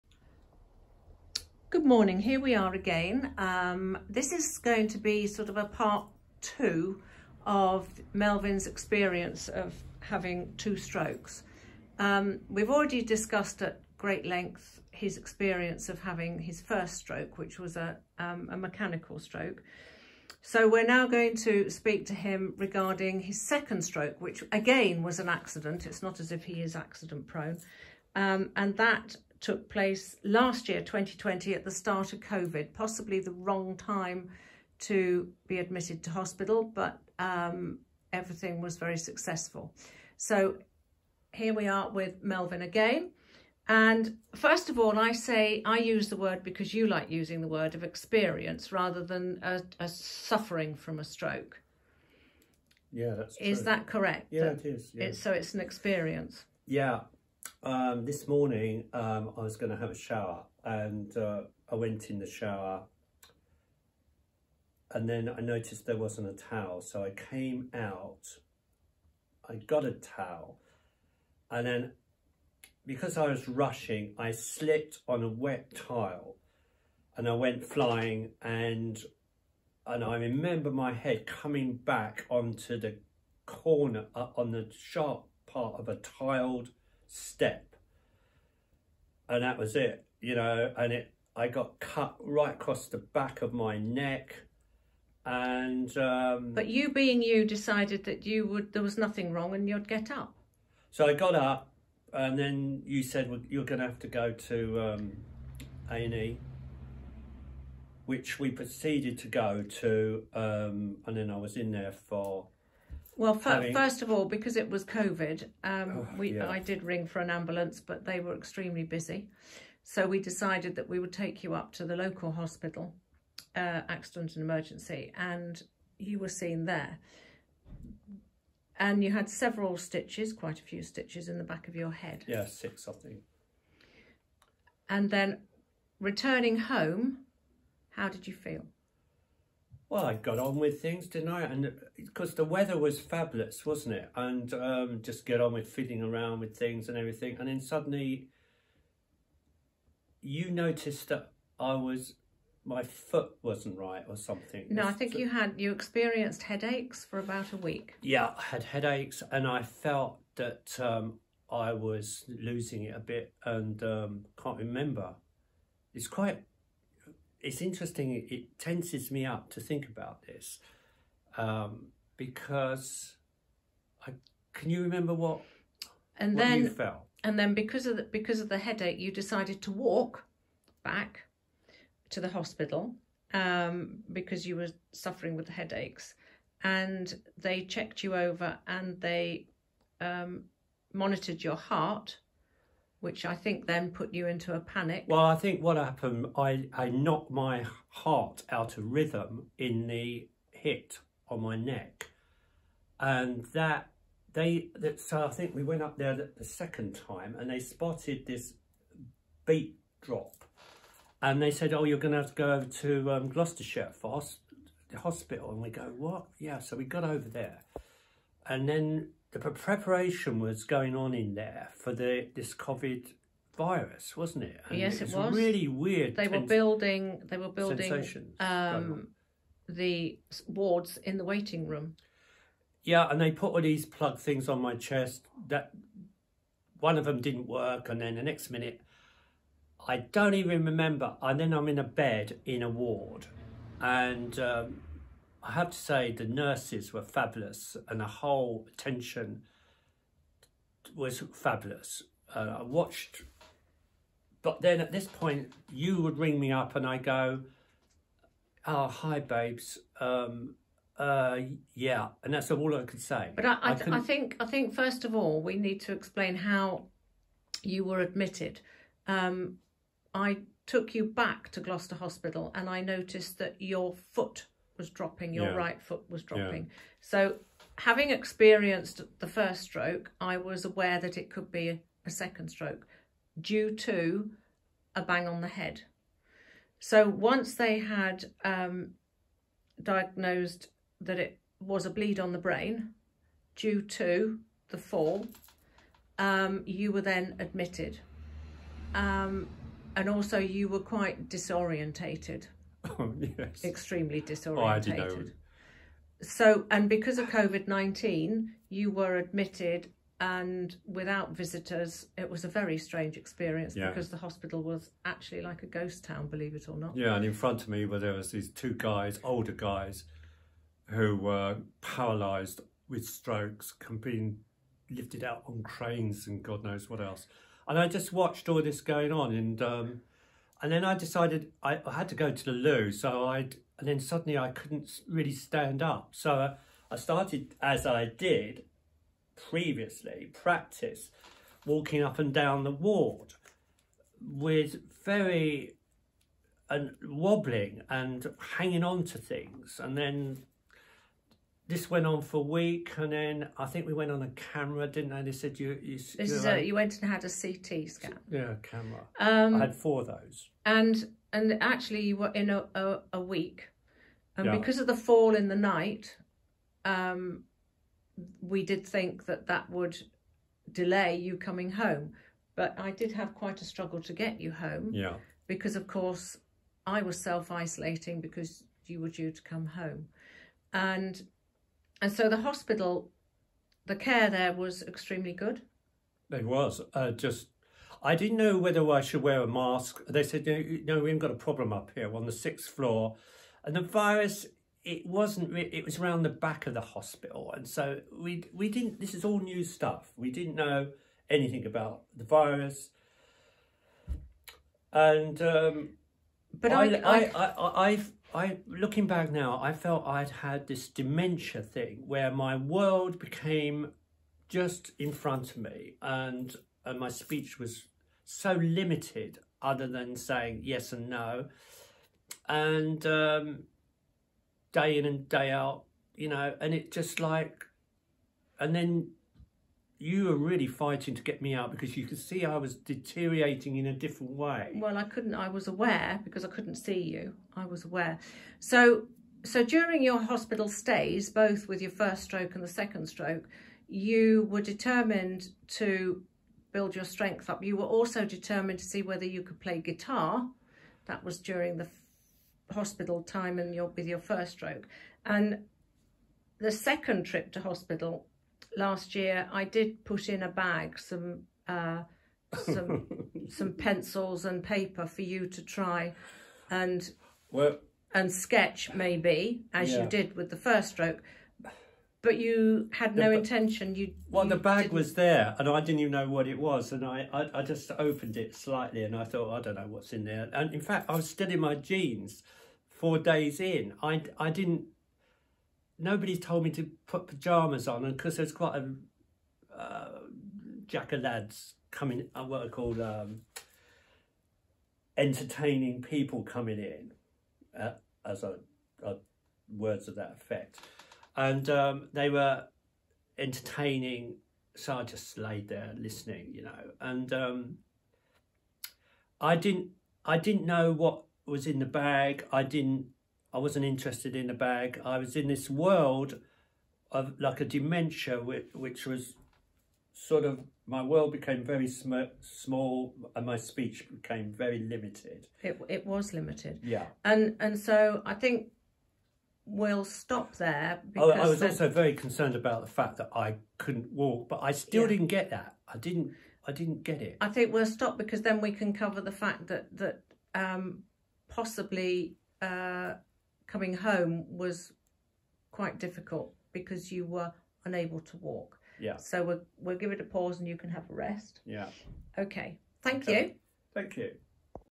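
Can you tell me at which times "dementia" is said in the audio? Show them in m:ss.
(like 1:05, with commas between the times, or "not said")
6:50, 8:37.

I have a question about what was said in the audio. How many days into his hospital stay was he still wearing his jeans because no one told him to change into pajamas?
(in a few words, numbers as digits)
4.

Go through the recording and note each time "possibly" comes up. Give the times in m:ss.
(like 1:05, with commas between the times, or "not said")
0:32, 9:01.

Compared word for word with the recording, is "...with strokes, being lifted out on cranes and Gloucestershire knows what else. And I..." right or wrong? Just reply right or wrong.
wrong.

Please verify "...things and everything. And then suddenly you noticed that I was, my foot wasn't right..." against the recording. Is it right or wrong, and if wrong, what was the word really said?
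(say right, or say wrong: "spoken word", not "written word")
right.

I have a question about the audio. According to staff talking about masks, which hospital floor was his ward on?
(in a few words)
The sixth floor.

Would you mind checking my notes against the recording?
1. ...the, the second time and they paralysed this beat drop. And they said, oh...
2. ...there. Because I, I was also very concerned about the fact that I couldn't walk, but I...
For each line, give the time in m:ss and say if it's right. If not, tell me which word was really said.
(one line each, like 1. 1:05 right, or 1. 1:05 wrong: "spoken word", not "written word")
1. 3:26 wrong: "spotted", not "paralysed"
2. 8:50 right.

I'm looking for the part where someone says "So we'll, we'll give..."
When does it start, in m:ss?
9:09.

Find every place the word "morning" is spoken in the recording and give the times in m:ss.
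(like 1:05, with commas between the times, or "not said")
0:01, 0:58.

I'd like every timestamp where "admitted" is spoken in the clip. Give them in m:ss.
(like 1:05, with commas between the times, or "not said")
0:35, 4:28, 4:57, 5:09.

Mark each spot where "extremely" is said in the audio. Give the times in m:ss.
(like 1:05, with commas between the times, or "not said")
1:58, 5:03, 6:24.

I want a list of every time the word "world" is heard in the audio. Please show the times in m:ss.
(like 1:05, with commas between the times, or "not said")
6:52, 8:35, 8:41.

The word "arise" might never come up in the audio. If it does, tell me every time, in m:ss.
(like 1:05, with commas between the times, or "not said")
not said.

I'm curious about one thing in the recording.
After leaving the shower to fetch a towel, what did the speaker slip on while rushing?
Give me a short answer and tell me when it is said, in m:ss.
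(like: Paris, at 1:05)
A wet tile, at 1:15.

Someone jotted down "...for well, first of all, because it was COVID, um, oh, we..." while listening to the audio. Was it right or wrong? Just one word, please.
right.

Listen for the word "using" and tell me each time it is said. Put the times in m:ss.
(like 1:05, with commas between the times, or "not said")
0:47.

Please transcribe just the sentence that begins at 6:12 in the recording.
But I did have quite a struggle to get you home.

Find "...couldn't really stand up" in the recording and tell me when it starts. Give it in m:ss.
5:34.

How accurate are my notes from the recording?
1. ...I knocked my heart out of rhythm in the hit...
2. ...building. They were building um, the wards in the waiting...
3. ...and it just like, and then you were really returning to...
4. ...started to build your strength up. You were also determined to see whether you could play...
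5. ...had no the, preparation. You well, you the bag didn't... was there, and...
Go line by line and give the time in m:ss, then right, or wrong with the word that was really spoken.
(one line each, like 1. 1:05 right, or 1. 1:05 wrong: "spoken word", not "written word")
1. 3:16 right
2. 3:46 right
3. 7:06 wrong: "fighting", not "returning"
4. 7:24 wrong: "determined", not "started"
5. 7:52 wrong: "intention", not "preparation".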